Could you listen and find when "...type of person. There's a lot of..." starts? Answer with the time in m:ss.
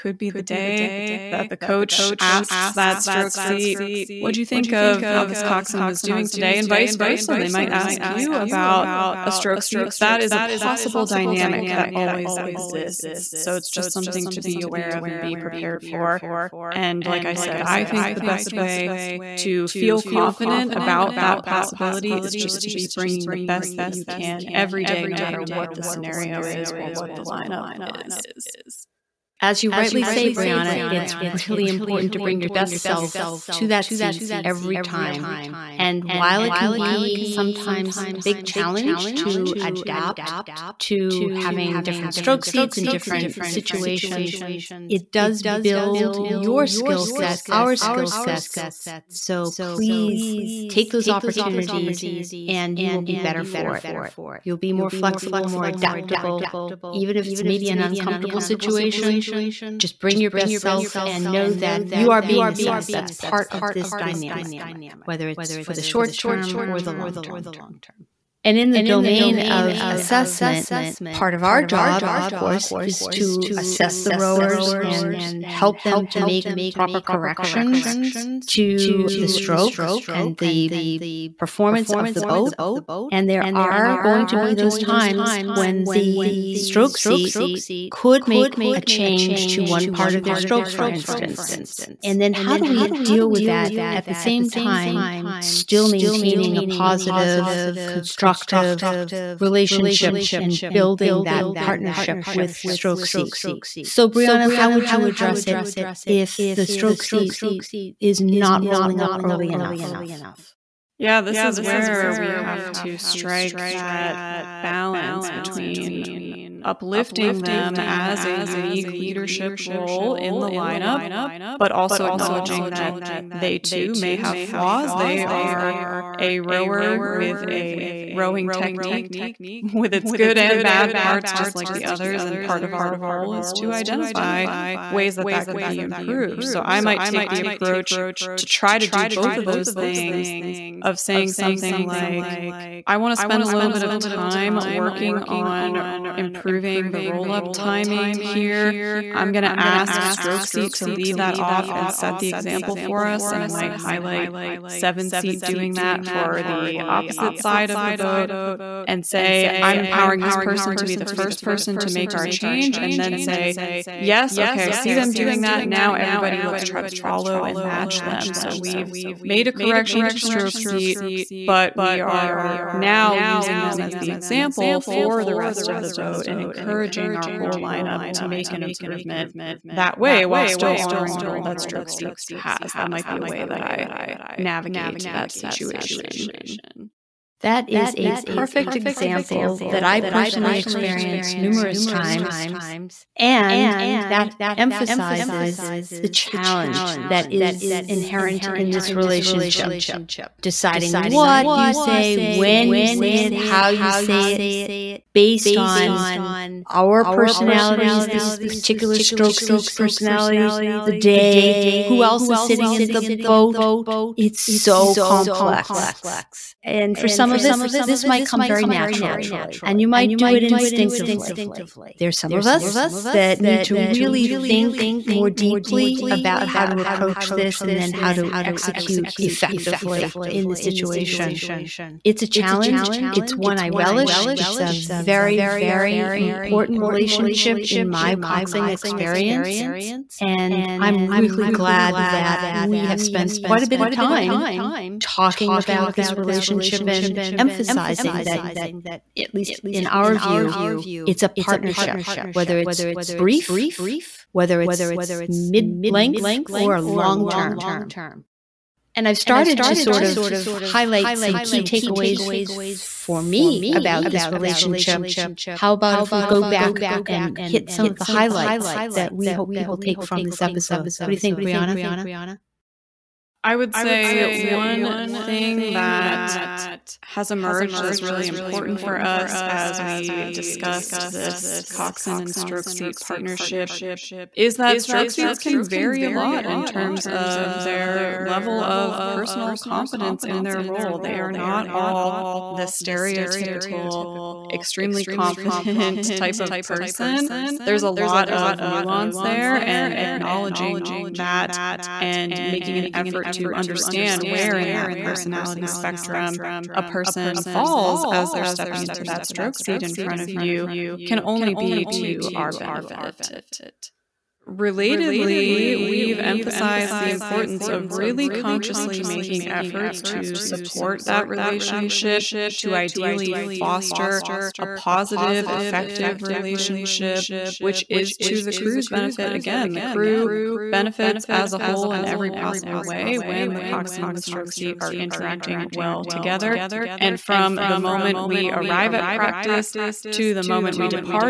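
4:56.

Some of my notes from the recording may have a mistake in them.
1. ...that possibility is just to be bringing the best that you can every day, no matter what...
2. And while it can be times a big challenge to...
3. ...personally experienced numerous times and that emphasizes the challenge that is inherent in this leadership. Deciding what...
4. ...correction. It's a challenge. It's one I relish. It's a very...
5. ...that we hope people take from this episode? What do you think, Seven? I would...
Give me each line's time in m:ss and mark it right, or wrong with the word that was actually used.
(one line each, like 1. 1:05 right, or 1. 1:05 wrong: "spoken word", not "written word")
1. 0:21 right
2. 0:35 wrong: "sometimes", not "times"
3. 3:10 wrong: "relationship", not "leadership"
4. 3:50 wrong: "situation", not "correction"
5. 4:28 wrong: "Brianna", not "Seven".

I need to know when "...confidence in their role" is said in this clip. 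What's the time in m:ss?
4:49.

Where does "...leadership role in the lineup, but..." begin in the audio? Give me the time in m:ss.
1:58.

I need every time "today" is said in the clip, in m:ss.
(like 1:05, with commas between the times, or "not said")
0:06.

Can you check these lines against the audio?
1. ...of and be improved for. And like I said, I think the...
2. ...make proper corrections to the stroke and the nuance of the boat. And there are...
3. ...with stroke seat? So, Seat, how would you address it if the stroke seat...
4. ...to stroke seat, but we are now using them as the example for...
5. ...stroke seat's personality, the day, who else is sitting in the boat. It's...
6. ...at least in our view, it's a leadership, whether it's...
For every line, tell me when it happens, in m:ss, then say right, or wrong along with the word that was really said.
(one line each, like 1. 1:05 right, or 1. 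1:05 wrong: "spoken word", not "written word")
1. 0:14 wrong: "prepared", not "improved"
2. 1:16 wrong: "performance", not "nuance"
3. 1:42 wrong: "Brianna", not "Seat"
4. 2:50 right
5. 3:28 right
6. 4:09 wrong: "partnership", not "leadership".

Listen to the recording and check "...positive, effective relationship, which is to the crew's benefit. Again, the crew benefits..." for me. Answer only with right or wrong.
right.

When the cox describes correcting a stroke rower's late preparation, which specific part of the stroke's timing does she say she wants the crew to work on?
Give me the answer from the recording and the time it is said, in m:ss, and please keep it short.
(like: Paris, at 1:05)
roll up timing, at 2:27.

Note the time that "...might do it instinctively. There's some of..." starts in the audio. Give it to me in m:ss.
3:39.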